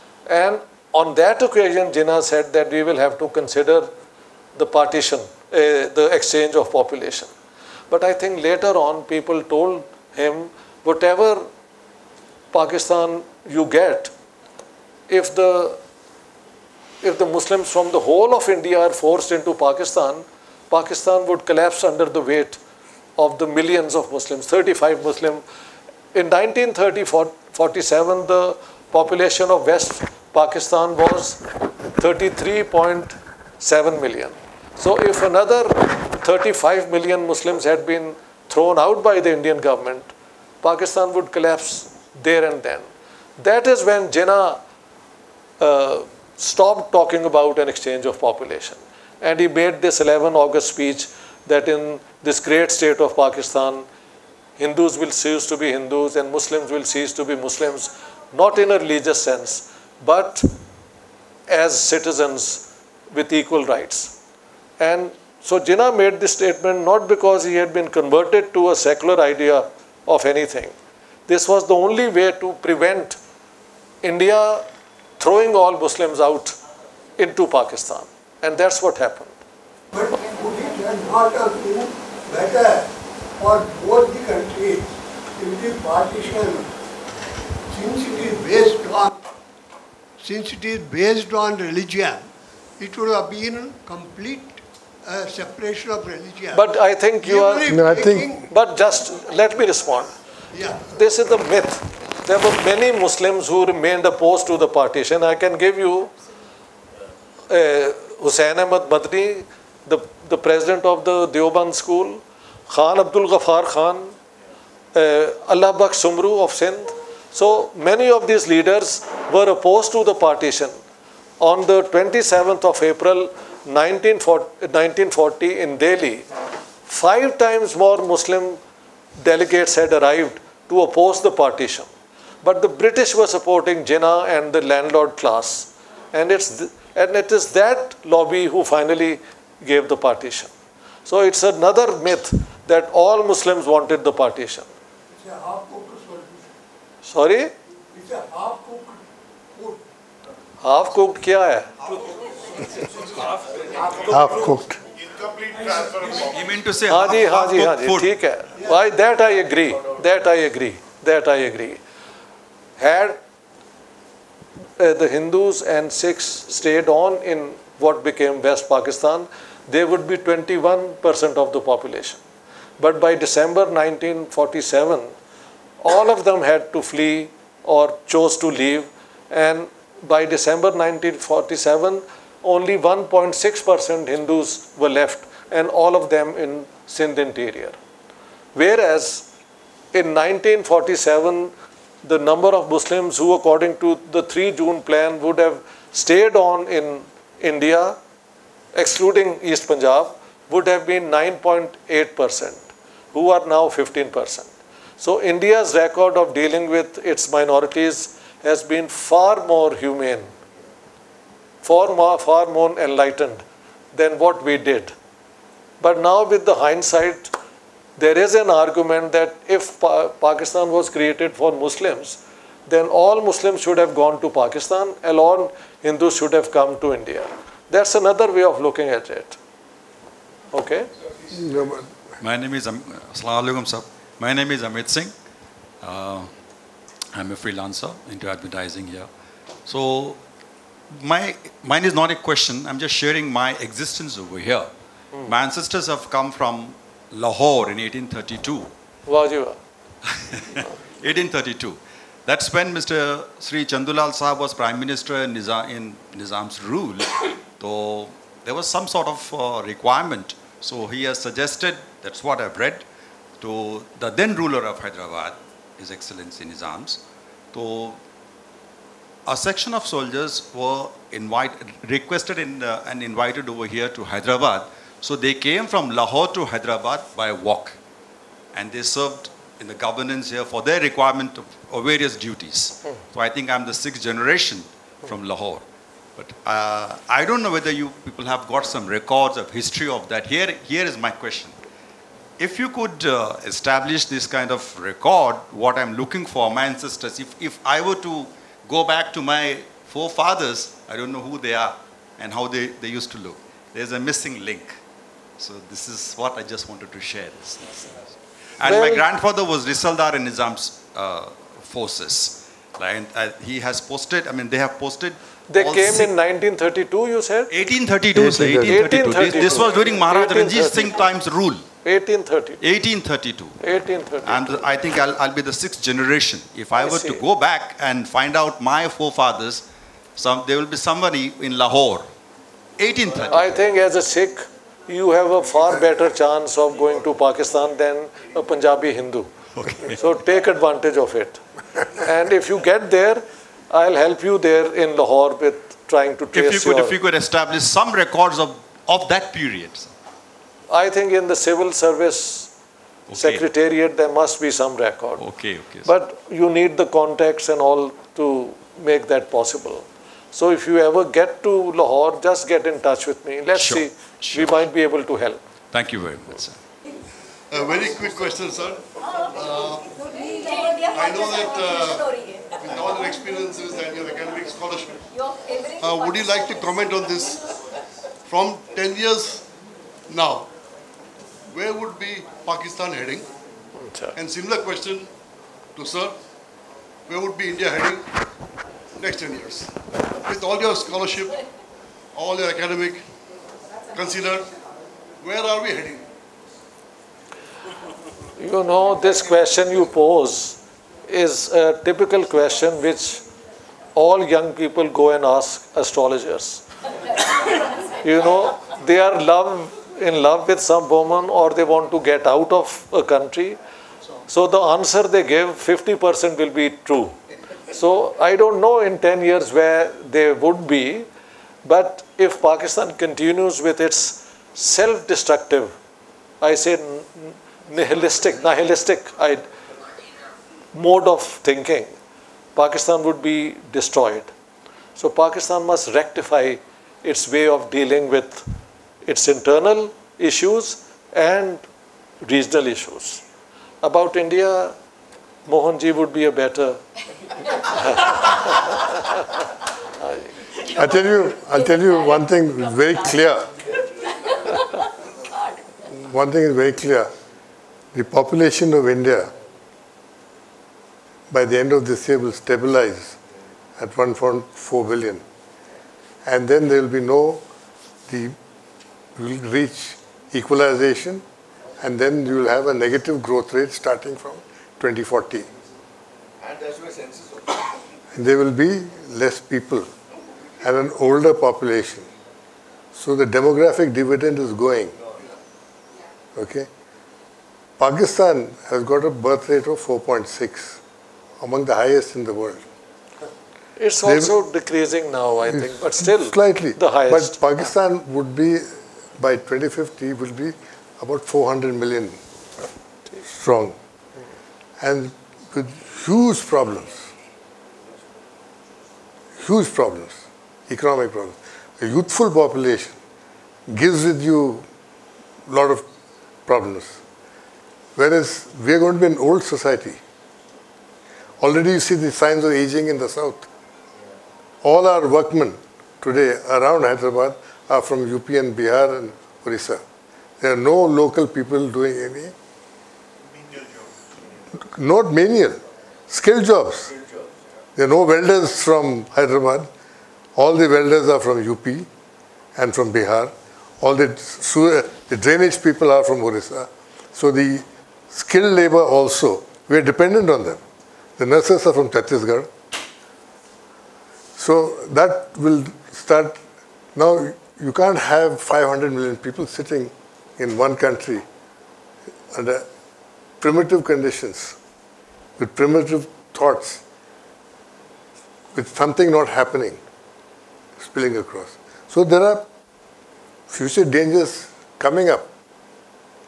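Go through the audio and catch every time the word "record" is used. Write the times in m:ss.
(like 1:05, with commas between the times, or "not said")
3:25, 4:48, 4:54, 5:47, 5:54.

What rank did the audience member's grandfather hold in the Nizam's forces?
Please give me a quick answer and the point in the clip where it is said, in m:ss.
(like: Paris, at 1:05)
Risaldar, at 5:09.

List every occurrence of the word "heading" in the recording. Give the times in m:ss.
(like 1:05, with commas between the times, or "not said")
6:22, 6:27, 6:35.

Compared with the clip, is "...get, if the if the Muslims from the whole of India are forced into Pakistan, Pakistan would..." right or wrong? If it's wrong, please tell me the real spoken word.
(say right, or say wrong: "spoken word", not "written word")
right.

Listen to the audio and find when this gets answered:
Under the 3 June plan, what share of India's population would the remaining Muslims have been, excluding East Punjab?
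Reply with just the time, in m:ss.
3:21.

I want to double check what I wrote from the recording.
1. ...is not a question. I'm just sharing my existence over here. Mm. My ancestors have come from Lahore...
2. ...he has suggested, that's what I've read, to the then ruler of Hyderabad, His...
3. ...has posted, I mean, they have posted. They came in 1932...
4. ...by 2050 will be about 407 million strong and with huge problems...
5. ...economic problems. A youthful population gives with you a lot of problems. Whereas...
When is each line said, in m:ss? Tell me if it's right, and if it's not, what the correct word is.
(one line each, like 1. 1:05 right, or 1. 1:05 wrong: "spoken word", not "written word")
1. 4:01 right
2. 4:20 right
3. 5:13 right
4. 8:19 wrong: "400", not "407"
5. 8:30 right.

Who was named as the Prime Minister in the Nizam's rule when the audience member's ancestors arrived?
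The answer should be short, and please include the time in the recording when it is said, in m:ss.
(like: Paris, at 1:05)
Chandulal, at 4:13.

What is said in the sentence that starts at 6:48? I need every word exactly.
you know, their love in love with some woman or they want to get out of a country.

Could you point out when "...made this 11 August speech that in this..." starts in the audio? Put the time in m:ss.
0:49.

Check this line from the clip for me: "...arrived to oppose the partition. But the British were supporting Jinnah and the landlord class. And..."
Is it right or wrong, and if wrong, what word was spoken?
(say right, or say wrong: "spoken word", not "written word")
right.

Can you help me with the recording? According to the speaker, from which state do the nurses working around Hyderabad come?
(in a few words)
Chhattisgarh.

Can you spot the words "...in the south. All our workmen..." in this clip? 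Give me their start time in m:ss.
8:42.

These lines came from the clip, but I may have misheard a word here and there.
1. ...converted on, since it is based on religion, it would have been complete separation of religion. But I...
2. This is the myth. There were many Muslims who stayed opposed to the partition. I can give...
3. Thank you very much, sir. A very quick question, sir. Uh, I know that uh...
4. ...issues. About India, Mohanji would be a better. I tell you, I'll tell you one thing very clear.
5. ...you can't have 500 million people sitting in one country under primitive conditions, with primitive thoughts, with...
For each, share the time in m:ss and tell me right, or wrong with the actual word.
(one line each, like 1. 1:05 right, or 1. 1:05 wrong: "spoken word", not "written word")
1. 1:28 wrong: "based", not "converted"
2. 1:40 wrong: "remained", not "stayed"
3. 6:05 right
4. 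7:22 right
5. 9:17 right.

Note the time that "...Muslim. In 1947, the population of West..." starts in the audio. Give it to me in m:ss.
0:25.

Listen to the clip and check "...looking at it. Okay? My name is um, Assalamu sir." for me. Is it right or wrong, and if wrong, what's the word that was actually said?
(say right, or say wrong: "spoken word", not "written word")
right.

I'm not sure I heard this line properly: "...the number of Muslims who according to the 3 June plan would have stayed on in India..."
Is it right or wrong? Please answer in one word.
right.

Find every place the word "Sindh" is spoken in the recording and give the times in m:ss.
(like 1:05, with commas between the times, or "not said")
1:56, 3:06.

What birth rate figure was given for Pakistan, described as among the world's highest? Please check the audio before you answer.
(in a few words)
4.6.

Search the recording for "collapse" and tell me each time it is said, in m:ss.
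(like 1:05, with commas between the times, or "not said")
0:21, 0:41.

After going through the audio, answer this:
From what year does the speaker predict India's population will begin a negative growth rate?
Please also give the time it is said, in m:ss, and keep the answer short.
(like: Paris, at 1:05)
2040, at 7:54.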